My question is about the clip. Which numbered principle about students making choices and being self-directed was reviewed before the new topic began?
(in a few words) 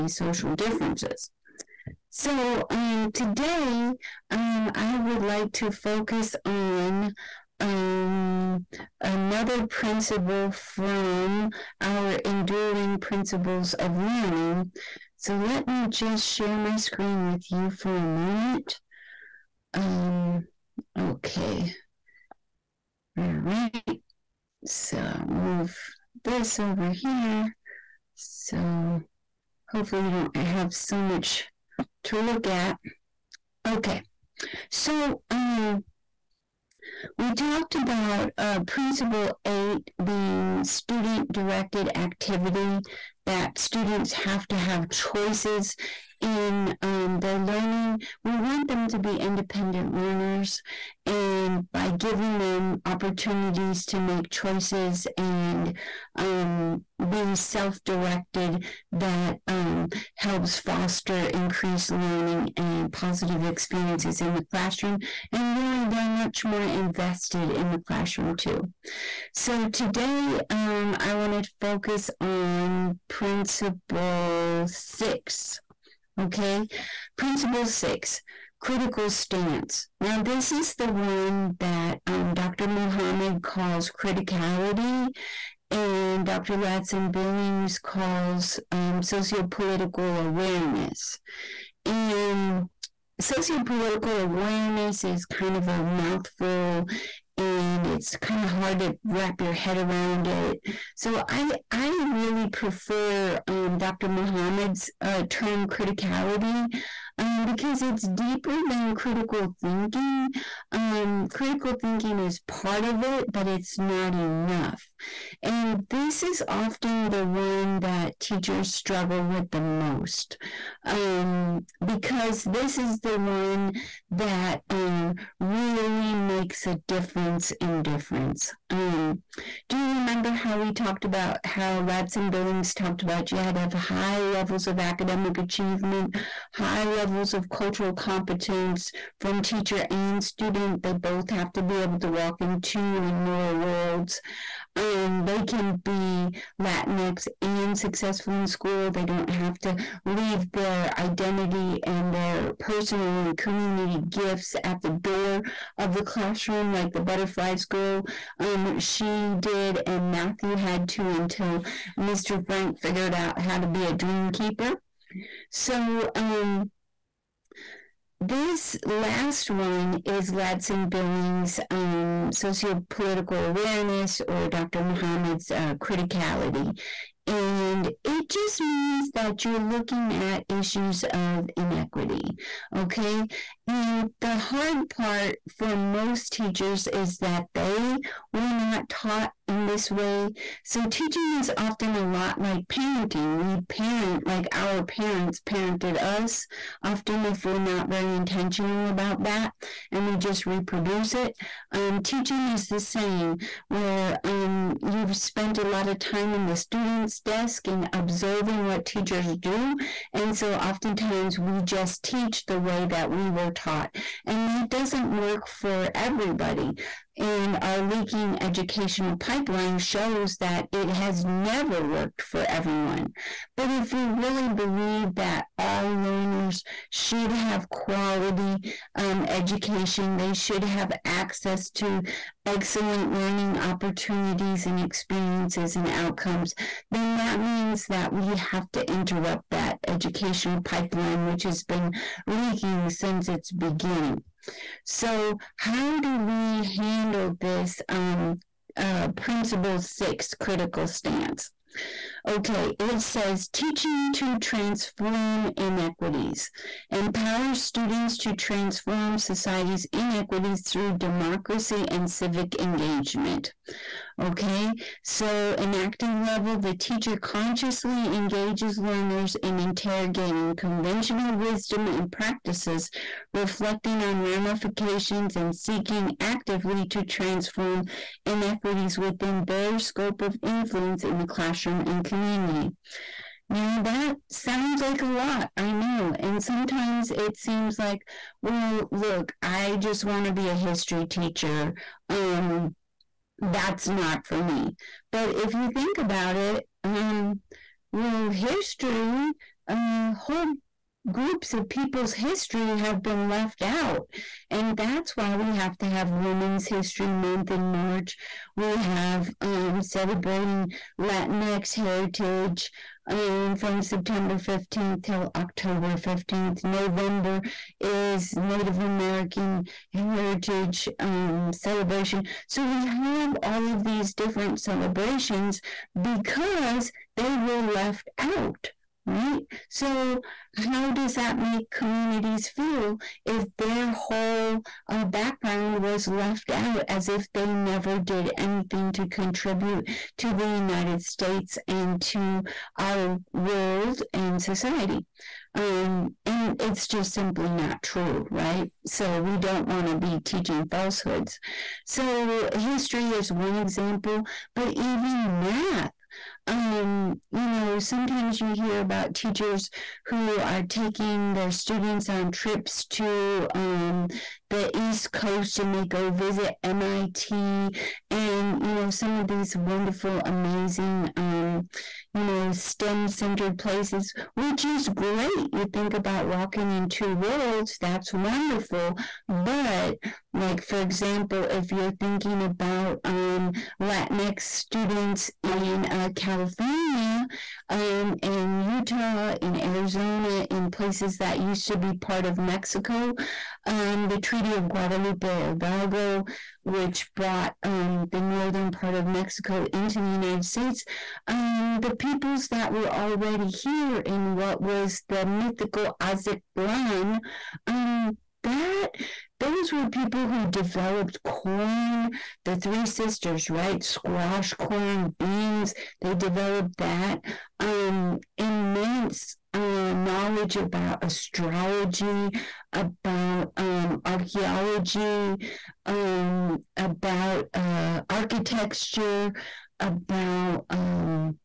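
Principle 8.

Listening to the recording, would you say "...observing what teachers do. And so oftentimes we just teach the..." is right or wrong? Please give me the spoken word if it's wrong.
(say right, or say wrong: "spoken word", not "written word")
right.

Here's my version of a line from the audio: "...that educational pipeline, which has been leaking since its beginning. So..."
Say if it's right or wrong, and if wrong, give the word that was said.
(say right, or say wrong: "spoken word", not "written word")
right.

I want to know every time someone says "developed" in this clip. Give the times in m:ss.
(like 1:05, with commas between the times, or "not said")
6:50, 6:56.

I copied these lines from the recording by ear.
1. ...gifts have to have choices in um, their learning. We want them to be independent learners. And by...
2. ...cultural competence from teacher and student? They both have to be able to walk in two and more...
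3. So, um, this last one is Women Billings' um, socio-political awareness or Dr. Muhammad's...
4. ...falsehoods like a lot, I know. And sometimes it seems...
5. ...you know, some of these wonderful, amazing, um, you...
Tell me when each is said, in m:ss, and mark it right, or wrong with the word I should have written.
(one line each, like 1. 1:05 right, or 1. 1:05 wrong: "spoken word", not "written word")
1. 0:43 wrong: "students", not "gifts"
2. 2:17 right
3. 2:45 wrong: "Ladson", not "Women"
4. 4:44 wrong: "sounds", not "falsehoods"
5. 6:08 right.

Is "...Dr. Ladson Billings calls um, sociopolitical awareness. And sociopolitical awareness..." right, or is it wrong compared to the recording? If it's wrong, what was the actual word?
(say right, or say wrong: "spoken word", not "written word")
right.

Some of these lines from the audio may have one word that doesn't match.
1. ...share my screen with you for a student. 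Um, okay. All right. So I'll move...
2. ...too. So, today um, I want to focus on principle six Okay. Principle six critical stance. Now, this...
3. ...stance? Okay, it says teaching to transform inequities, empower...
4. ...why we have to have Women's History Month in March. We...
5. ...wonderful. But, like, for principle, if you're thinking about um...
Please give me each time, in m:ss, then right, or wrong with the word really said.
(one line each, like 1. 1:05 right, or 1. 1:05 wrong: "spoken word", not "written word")
1. 0:16 wrong: "moment", not "student"
2. 1:08 right
3. 4:10 right
4. 5:05 right
5. 6:18 wrong: "example", not "principle".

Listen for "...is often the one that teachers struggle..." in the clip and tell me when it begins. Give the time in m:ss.
1:56.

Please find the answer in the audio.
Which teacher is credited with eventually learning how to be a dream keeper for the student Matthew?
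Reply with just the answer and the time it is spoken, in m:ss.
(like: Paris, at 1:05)
Mr. Frank, at 2:41.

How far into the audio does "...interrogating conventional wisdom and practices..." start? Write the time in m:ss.
4:29.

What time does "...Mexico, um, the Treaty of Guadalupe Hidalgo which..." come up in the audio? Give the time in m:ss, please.
6:32.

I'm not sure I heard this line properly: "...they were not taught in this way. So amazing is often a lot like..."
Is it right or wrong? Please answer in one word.
wrong.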